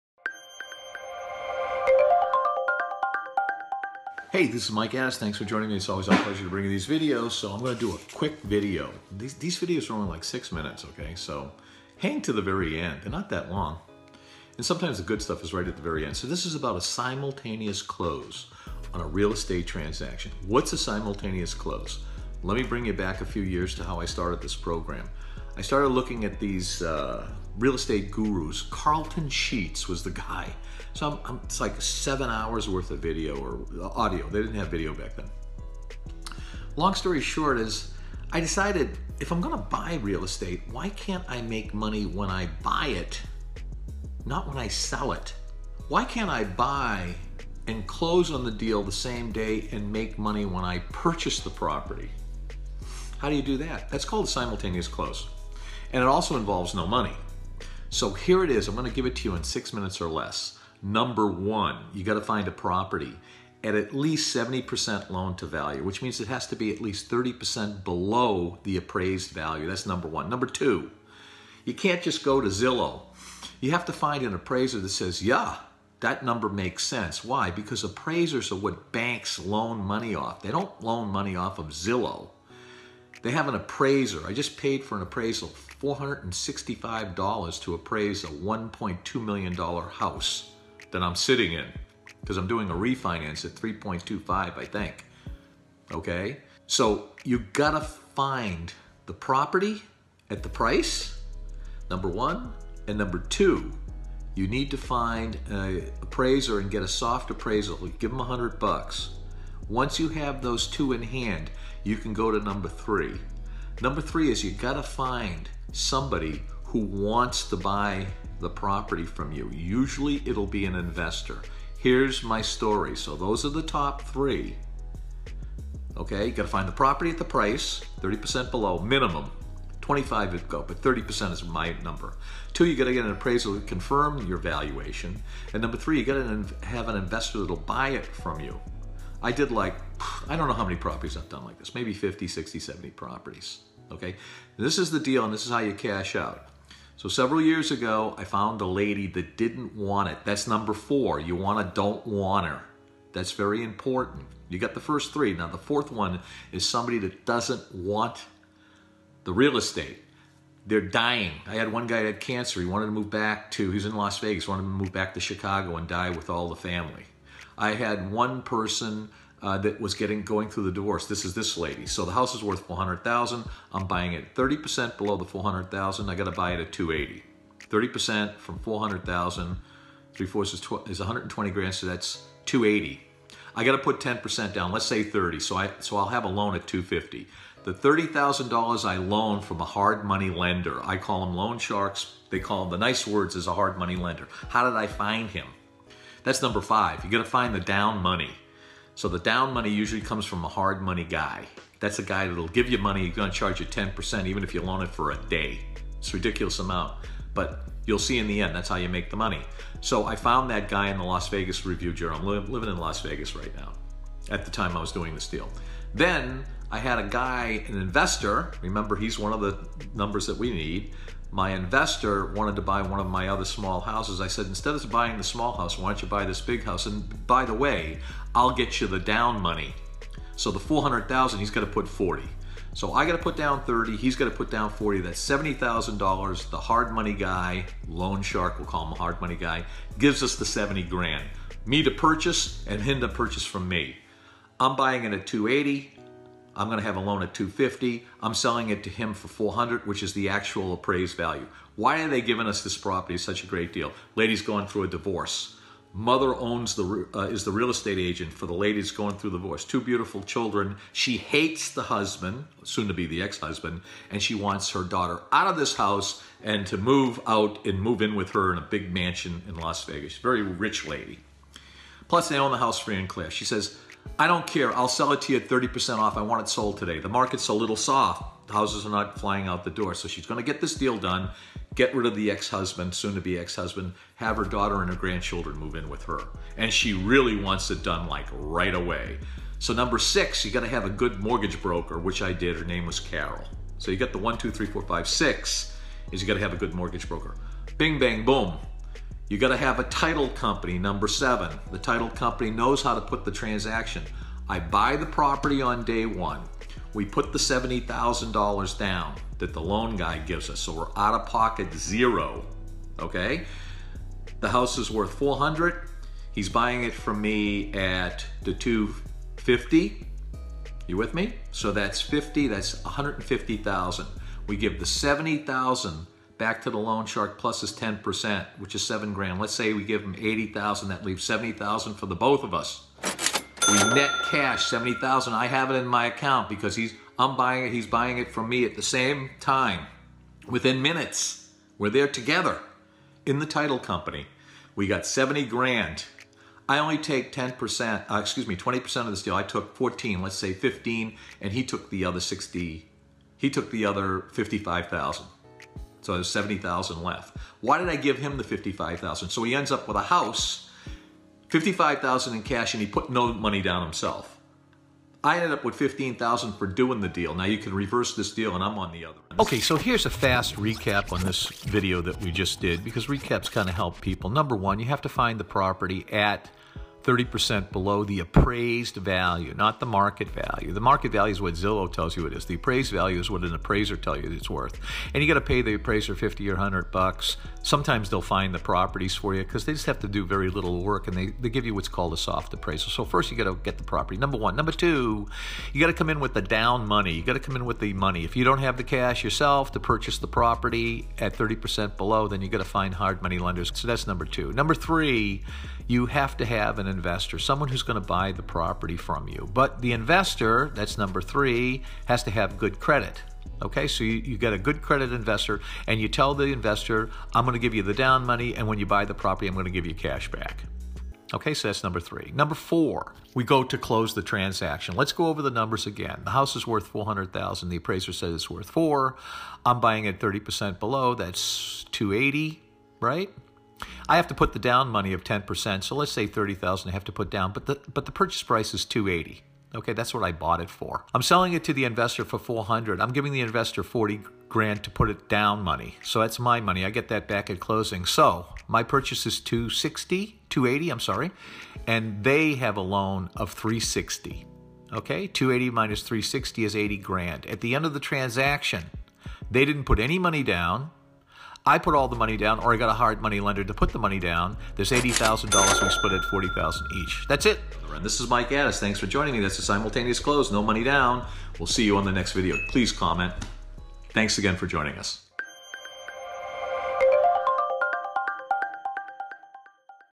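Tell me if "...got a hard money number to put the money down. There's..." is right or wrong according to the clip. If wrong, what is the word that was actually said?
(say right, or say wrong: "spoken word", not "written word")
wrong: "lender", not "number".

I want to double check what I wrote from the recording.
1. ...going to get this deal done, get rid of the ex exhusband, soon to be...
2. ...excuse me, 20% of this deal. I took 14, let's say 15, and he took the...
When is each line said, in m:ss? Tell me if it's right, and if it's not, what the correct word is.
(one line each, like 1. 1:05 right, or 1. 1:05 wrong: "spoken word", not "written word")
1. 4:40 wrong: "husband", not "exhusband"
2. 5:48 right.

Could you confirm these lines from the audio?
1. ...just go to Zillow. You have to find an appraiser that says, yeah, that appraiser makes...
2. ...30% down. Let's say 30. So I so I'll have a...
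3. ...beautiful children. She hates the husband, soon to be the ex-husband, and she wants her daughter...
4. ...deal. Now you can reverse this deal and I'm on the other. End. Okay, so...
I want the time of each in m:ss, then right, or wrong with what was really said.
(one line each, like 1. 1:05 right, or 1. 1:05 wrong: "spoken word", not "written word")
1. 1:12 wrong: "number", not "appraiser"
2. 3:03 wrong: "10", not "30"
3. 4:19 right
4. 6:07 right.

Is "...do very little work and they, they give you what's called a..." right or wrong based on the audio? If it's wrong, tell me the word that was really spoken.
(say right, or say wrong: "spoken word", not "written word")
right.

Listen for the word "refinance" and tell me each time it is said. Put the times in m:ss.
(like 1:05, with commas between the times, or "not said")
1:32.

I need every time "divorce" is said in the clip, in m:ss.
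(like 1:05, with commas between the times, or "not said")
2:50, 4:14, 4:19.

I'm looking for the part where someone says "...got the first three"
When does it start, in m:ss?
2:34.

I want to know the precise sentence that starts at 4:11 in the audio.
Why are they giving us this property such a great deal?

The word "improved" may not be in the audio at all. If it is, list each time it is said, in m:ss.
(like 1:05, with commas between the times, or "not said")
not said.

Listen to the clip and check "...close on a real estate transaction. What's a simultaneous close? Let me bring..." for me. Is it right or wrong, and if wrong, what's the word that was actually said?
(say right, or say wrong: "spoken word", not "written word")
right.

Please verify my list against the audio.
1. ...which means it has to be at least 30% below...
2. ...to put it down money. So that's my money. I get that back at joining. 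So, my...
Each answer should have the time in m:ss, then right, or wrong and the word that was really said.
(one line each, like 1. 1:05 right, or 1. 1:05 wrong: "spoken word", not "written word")
1. 1:05 right
2. 7:24 wrong: "closing", not "joining".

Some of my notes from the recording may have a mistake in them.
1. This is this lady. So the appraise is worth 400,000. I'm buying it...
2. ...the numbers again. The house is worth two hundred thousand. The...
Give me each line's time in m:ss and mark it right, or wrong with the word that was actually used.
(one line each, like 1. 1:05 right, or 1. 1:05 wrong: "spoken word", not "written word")
1. 2:51 wrong: "house", not "appraise"
2. 7:05 wrong: "four", not "two".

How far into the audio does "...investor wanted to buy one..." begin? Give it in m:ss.
3:41.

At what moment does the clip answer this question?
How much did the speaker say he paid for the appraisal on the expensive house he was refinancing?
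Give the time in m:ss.
1:25.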